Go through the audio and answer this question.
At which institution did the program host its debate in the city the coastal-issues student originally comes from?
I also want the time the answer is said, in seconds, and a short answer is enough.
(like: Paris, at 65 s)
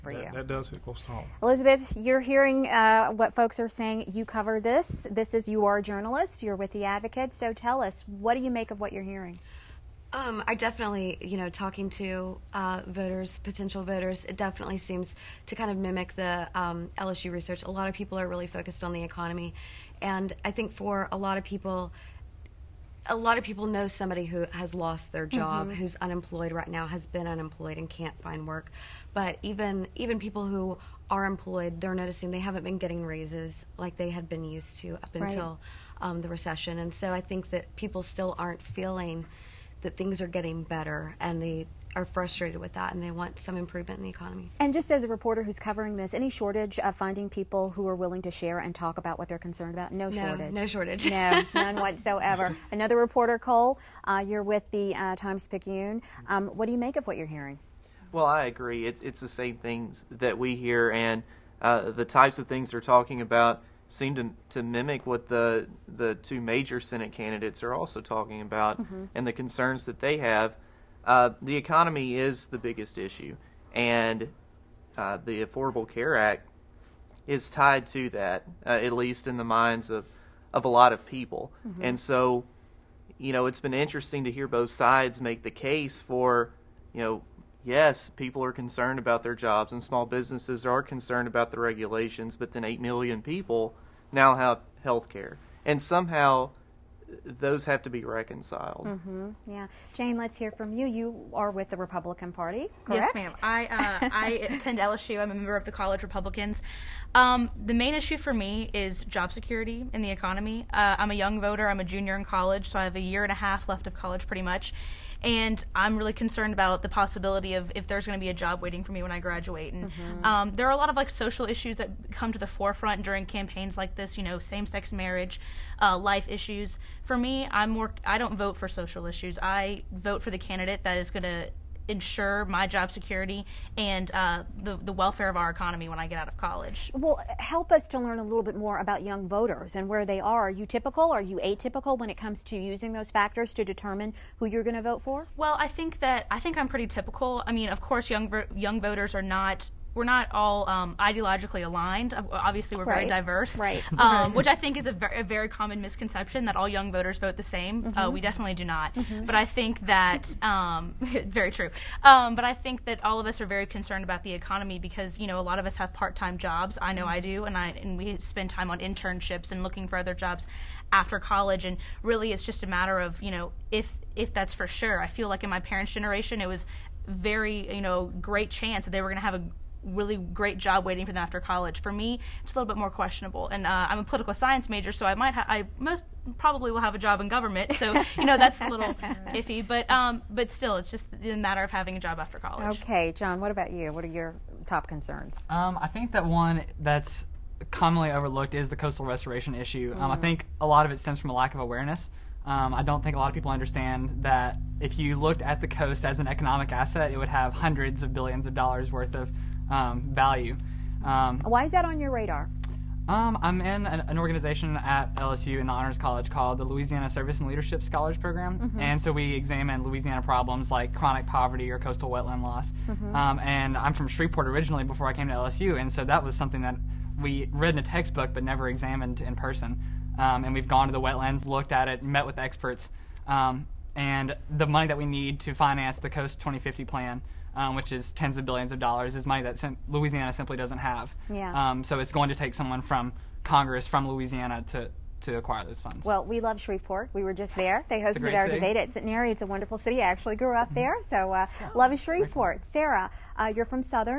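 Centenary, at 248 s.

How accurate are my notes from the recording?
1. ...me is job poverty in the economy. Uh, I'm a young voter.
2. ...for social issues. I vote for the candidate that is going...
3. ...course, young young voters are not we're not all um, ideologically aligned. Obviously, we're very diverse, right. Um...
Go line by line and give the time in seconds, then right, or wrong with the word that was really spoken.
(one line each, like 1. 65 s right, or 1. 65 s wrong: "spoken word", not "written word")
1. 108 s wrong: "security", not "poverty"
2. 128 s right
3. 147 s right.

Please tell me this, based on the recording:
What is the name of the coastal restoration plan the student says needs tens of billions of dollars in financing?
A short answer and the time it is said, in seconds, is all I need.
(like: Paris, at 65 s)
Coast 2050, at 236 s.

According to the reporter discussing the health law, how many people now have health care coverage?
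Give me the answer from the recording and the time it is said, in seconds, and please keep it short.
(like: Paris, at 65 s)
8 million, at 92 s.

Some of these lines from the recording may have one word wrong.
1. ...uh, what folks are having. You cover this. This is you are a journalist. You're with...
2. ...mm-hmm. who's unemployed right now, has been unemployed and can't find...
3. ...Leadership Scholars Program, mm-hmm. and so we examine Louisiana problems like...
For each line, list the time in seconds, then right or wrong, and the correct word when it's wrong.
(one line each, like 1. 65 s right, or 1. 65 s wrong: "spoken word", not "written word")
1. 2 s wrong: "saying", not "having"
2. 25 s right
3. 217 s right.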